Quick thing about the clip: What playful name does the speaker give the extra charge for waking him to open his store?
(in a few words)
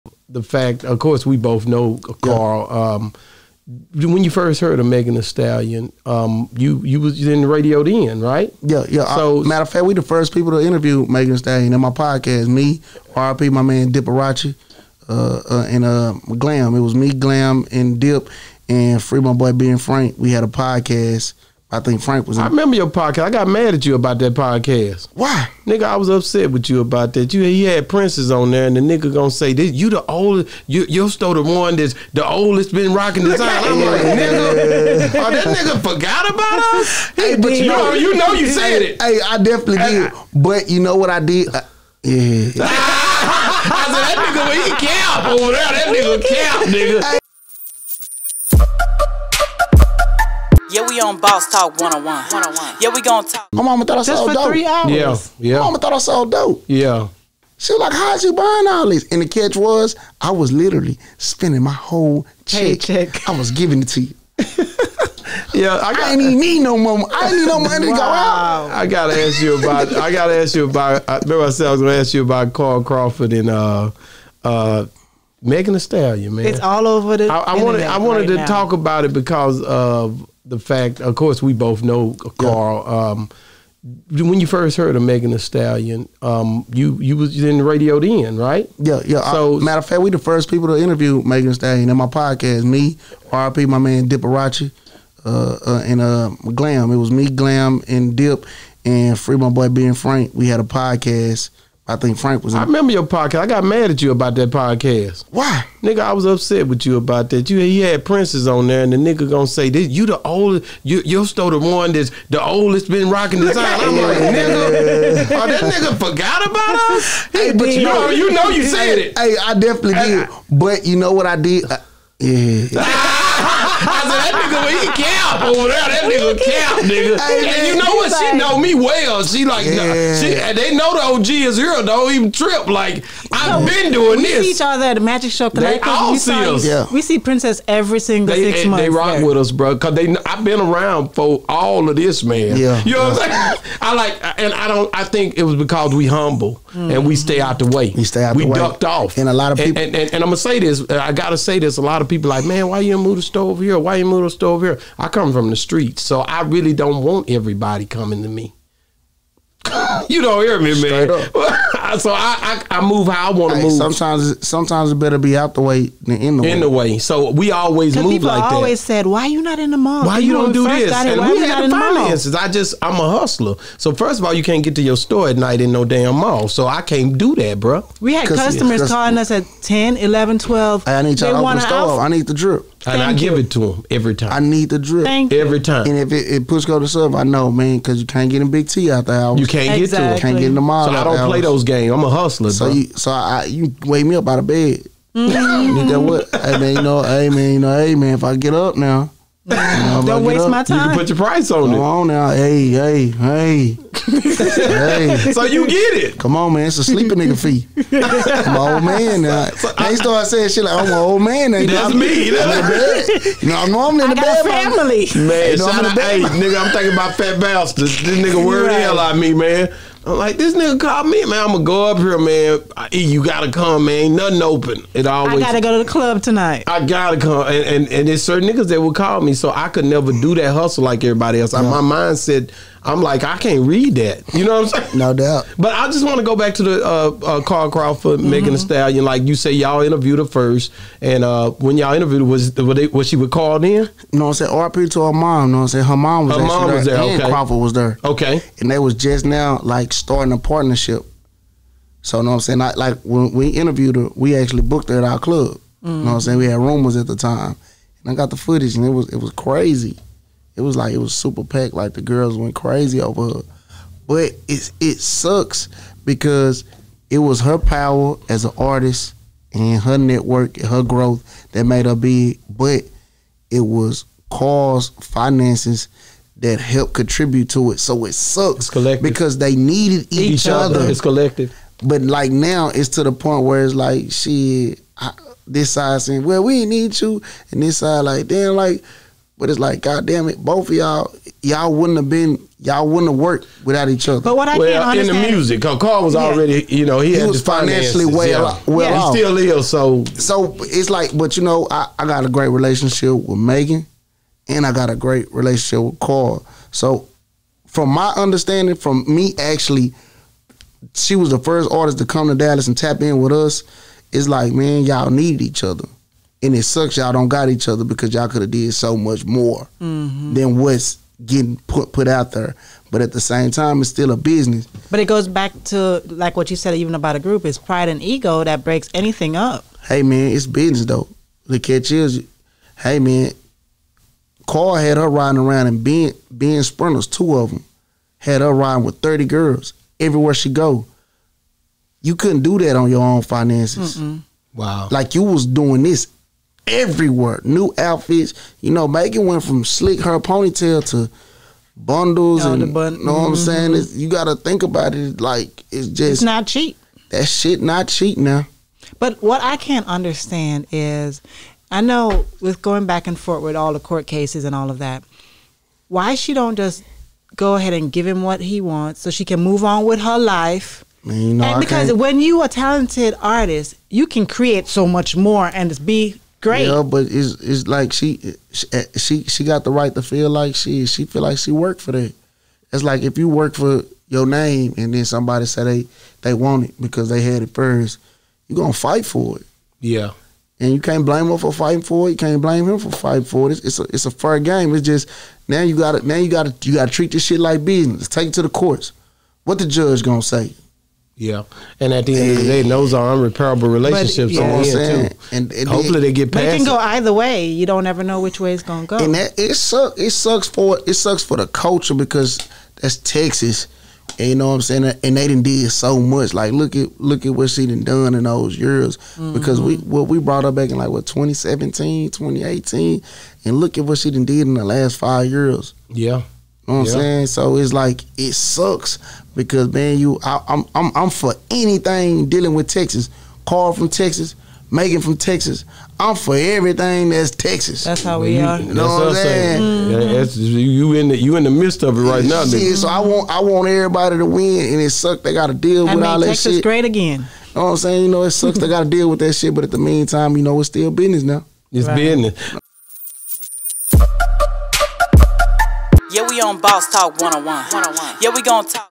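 Sleeping nigga fee.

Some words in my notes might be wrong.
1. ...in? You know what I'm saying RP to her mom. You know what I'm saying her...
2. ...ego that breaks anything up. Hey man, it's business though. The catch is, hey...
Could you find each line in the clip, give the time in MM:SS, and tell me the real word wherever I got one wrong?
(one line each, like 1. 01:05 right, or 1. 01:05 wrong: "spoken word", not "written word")
1. 04:03 right
2. 05:28 right.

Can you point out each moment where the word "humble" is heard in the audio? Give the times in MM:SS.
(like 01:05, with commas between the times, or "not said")
02:26.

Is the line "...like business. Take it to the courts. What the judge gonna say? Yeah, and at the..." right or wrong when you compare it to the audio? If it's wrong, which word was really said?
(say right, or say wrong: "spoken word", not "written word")
right.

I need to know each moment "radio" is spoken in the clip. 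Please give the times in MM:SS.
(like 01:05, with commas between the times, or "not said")
00:07, 01:27.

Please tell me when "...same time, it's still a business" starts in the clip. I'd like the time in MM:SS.
05:23.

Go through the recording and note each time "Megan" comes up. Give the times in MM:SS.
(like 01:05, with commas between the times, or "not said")
00:04, 00:11, 01:15, 01:25, 01:31, 05:03, 05:48, 07:14.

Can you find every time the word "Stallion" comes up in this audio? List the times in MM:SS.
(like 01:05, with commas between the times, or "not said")
00:05, 00:11, 01:15, 01:25, 01:31, 03:58.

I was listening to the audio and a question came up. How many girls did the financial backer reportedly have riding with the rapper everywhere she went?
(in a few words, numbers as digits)
30.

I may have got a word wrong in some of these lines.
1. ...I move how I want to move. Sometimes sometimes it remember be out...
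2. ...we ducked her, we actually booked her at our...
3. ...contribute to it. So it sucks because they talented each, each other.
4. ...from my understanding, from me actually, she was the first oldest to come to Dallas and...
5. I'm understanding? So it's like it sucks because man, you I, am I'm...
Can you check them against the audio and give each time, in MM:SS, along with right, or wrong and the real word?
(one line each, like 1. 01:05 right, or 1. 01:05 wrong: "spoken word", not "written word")
1. 02:42 wrong: "better", not "remember"
2. 04:13 wrong: "interviewed", not "ducked"
3. 04:36 wrong: "needed", not "talented"
4. 05:07 wrong: "artist", not "oldest"
5. 07:06 wrong: "saying", not "understanding".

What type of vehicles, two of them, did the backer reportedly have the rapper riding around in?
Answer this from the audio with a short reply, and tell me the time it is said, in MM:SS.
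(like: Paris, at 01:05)
Sprinters, at 05:36.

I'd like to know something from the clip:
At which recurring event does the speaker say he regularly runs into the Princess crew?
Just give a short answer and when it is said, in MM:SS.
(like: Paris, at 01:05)
The Magic Show, at 02:14.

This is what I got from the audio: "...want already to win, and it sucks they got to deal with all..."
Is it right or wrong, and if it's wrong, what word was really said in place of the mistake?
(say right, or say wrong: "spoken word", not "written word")
wrong: "everybody", not "already".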